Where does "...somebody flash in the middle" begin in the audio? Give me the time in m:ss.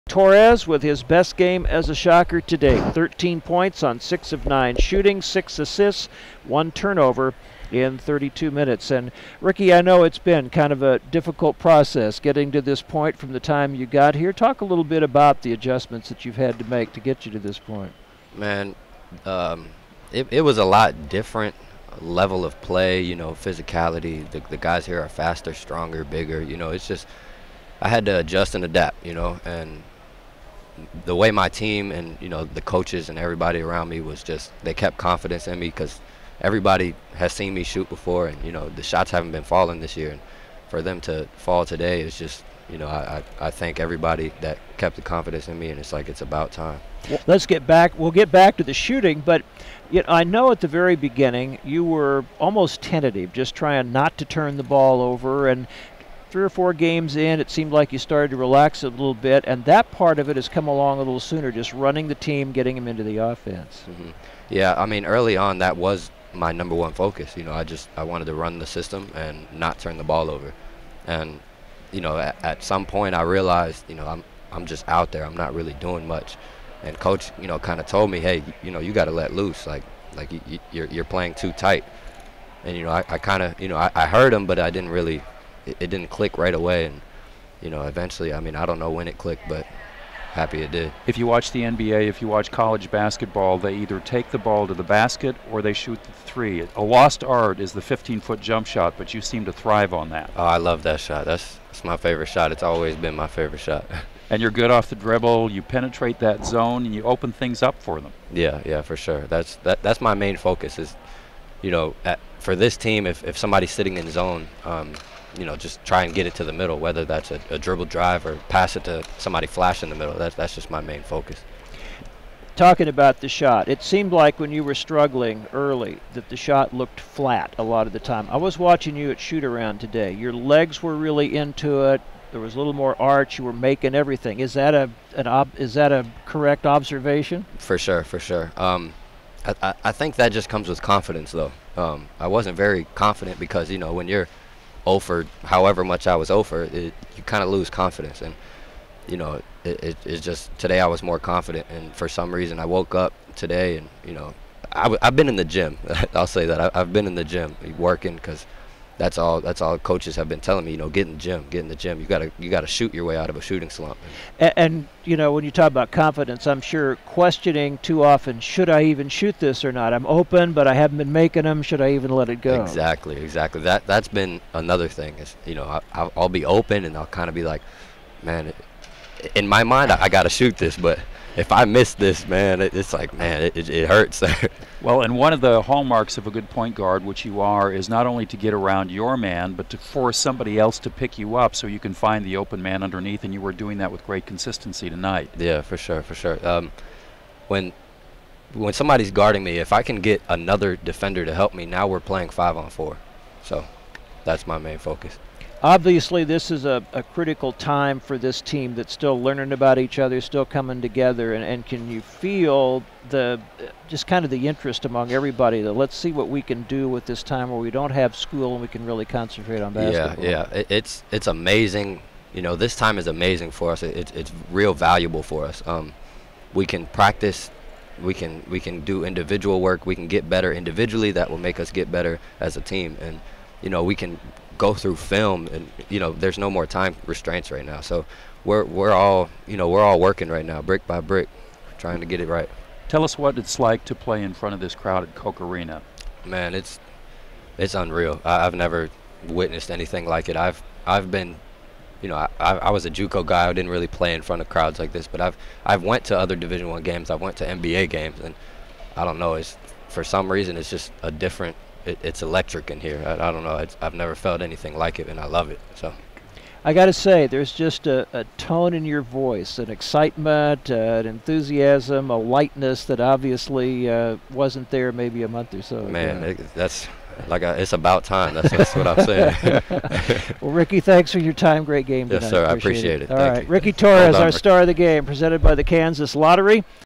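1:59.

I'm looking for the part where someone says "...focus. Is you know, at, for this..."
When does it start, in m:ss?
1:50.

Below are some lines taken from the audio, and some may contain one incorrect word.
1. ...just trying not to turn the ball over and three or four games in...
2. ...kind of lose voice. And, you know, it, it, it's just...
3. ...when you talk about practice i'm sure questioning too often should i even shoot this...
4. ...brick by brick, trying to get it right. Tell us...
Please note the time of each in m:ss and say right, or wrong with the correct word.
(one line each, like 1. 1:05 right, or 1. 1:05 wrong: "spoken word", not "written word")
1. 0:53 right
2. 2:27 wrong: "confidence", not "voice"
3. 2:45 wrong: "confidence", not "practice"
4. 4:00 right.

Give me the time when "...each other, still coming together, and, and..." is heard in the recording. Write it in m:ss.
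3:29.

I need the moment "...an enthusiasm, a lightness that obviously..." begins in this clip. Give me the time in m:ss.
4:30.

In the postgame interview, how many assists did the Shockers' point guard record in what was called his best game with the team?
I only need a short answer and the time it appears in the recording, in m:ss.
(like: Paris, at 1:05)
6, at 0:05.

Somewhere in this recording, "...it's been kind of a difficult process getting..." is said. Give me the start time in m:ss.
0:10.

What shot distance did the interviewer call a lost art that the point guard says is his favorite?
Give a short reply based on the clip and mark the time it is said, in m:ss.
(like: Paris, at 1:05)
15-foot, at 1:37.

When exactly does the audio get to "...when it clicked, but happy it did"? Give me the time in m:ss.
1:28.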